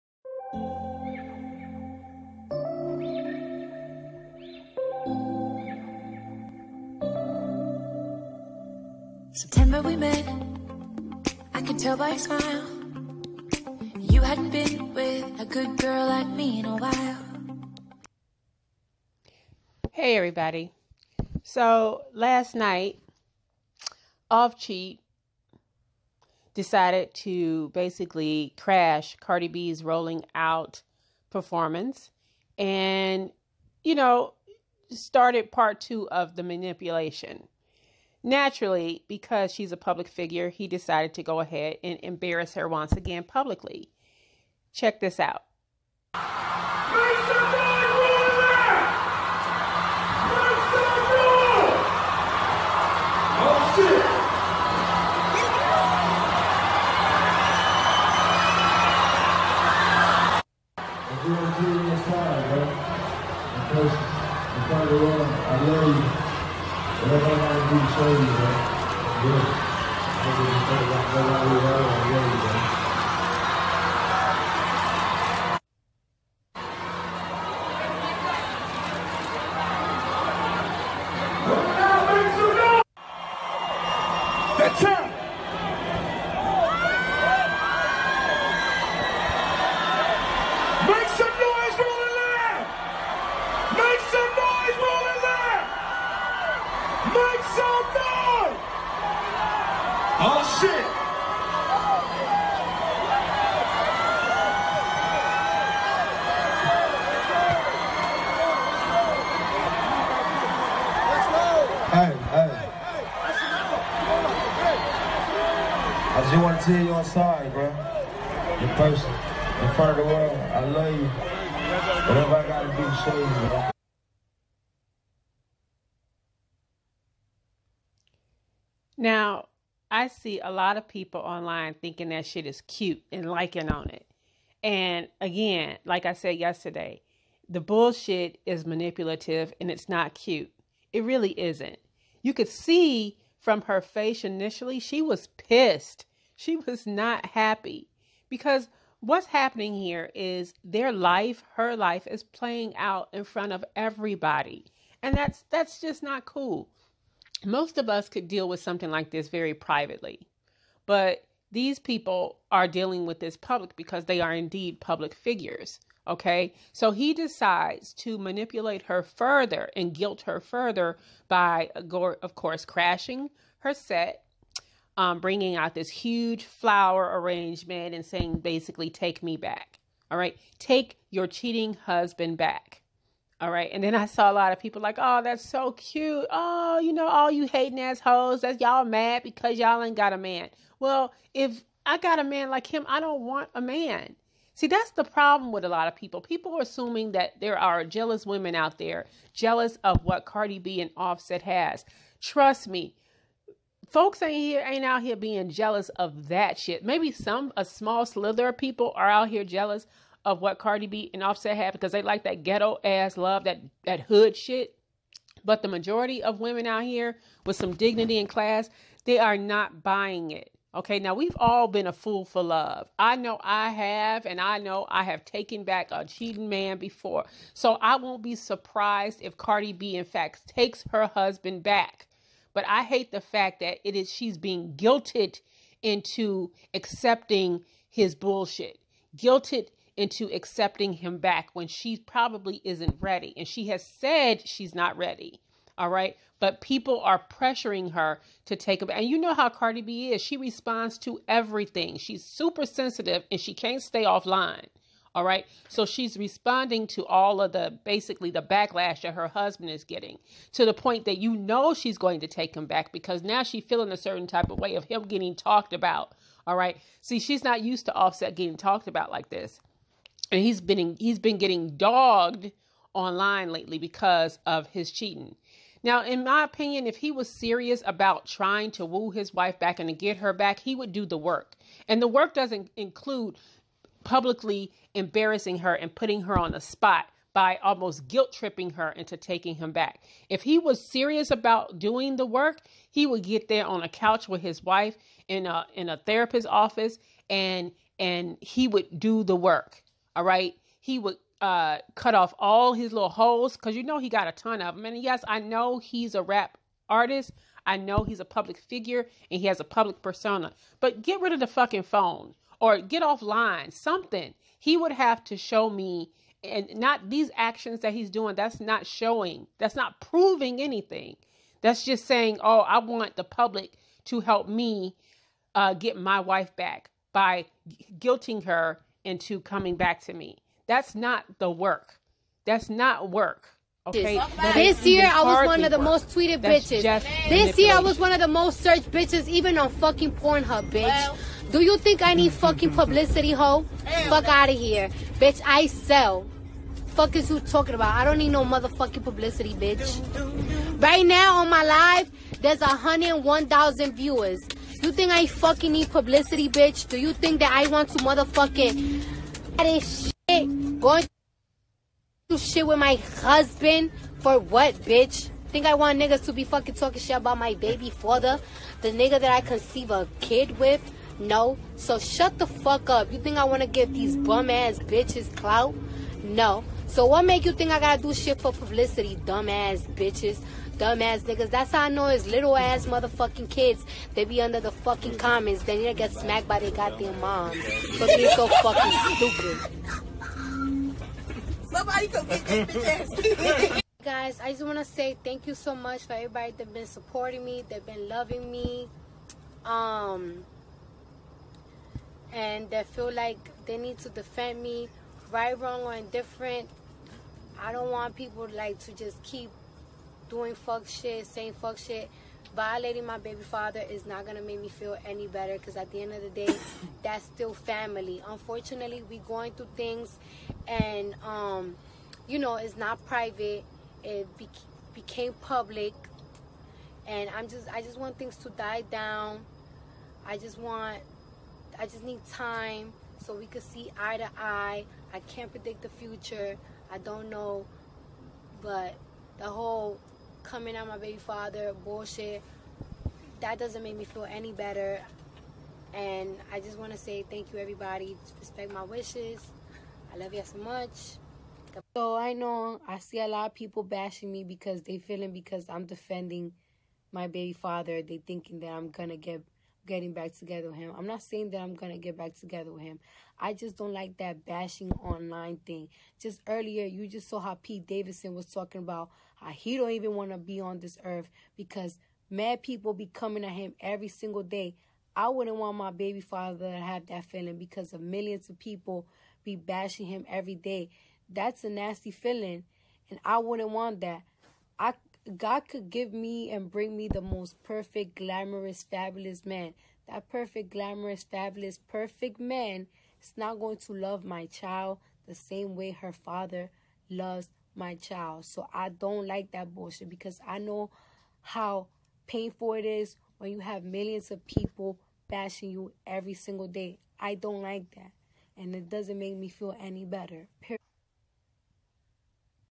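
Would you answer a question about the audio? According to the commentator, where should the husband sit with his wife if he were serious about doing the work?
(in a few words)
a therapist's office.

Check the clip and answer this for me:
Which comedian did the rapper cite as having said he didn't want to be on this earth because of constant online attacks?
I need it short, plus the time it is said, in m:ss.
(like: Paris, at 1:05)
Pete Davidson, at 7:47.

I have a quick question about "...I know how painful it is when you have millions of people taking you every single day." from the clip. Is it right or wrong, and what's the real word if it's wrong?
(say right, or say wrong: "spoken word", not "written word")
wrong: "bashing", not "taking".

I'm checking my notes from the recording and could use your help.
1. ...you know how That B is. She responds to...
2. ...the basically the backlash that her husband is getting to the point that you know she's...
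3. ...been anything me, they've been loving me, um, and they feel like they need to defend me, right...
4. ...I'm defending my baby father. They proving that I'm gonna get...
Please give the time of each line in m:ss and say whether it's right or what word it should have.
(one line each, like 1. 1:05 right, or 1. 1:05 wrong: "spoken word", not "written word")
1. 4:09 wrong: "Cardi", not "That"
2. 4:17 right
3. 6:36 wrong: "supporting", not "anything"
4. 7:35 wrong: "thinking", not "proving".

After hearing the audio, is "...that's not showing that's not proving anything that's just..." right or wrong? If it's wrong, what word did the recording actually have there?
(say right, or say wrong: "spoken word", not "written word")
right.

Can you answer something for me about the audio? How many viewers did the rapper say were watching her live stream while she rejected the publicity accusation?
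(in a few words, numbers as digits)
101,000.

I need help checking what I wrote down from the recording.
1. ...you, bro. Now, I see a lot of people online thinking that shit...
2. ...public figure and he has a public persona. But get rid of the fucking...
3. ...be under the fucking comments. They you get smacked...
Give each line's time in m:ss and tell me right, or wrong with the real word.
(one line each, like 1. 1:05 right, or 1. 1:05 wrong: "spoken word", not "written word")
1. 2:03 right
2. 5:08 right
3. 6:24 right.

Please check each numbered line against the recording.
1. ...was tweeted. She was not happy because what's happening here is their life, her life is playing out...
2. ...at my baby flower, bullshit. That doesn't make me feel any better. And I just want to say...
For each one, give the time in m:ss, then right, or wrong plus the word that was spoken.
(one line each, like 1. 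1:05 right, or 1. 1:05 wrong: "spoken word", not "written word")
1. 2:25 wrong: "pissed", not "tweeted"
2. 7:20 wrong: "father", not "flower".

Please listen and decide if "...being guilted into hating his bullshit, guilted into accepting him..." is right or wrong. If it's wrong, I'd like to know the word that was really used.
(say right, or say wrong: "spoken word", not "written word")
wrong: "accepting", not "hating".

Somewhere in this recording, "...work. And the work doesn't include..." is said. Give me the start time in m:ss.
4:41.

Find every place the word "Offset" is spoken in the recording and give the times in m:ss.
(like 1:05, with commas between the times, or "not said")
3:20, 3:31, 4:27.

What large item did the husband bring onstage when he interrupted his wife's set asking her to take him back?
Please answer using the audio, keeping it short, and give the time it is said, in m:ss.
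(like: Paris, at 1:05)
flower arrangement, at 2:55.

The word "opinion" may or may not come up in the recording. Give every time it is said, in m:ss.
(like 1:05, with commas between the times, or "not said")
4:36.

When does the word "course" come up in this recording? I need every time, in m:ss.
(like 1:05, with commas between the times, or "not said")
2:52.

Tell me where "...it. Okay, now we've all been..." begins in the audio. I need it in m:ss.
3:40.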